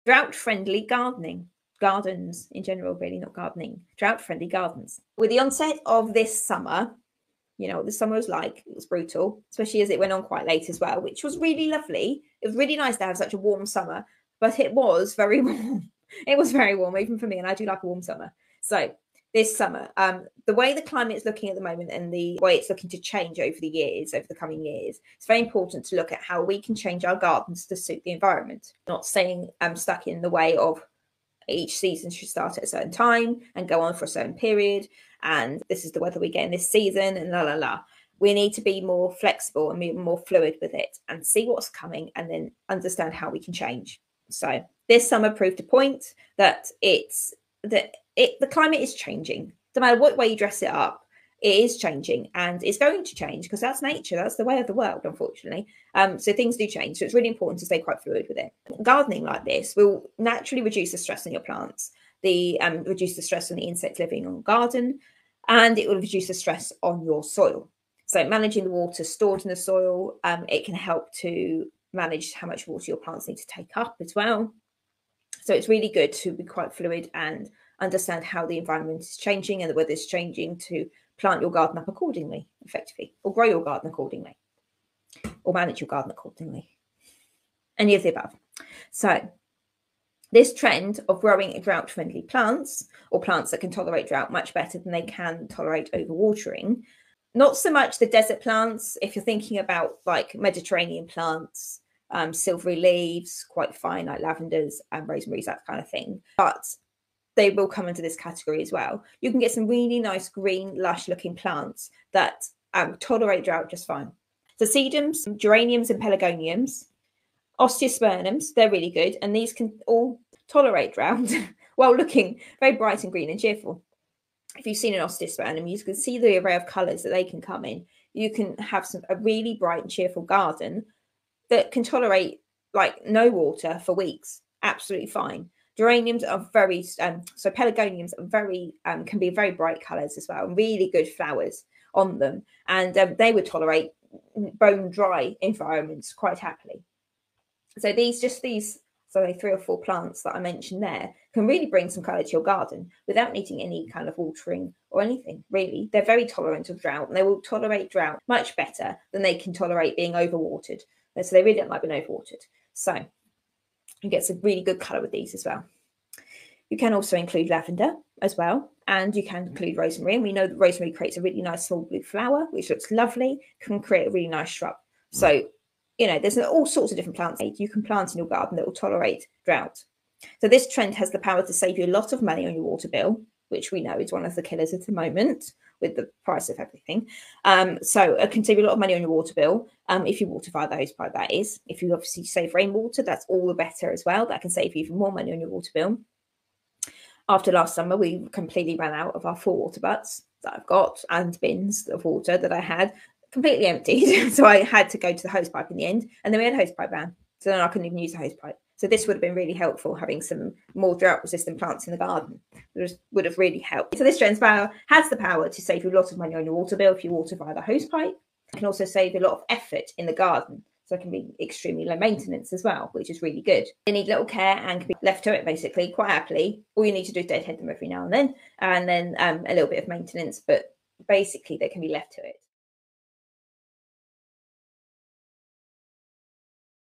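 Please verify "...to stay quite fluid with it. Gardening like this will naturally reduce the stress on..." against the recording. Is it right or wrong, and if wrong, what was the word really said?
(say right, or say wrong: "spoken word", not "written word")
right.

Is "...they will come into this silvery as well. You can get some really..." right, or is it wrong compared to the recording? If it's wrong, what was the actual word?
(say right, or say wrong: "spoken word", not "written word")
wrong: "category", not "silvery".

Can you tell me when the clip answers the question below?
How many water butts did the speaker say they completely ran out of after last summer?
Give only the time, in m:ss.
3:19.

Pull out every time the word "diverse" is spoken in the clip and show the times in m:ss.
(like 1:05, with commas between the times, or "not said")
not said.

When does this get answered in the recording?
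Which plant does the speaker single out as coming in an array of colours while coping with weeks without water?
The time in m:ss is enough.
2:04.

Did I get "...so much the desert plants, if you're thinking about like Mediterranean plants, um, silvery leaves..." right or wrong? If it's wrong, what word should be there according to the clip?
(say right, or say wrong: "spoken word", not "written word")
right.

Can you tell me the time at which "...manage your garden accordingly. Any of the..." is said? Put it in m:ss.
1:25.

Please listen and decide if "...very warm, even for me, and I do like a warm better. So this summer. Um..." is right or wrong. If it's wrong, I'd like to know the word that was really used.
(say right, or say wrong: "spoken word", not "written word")
wrong: "summer", not "better".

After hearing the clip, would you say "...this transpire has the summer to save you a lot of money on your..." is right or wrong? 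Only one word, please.
wrong.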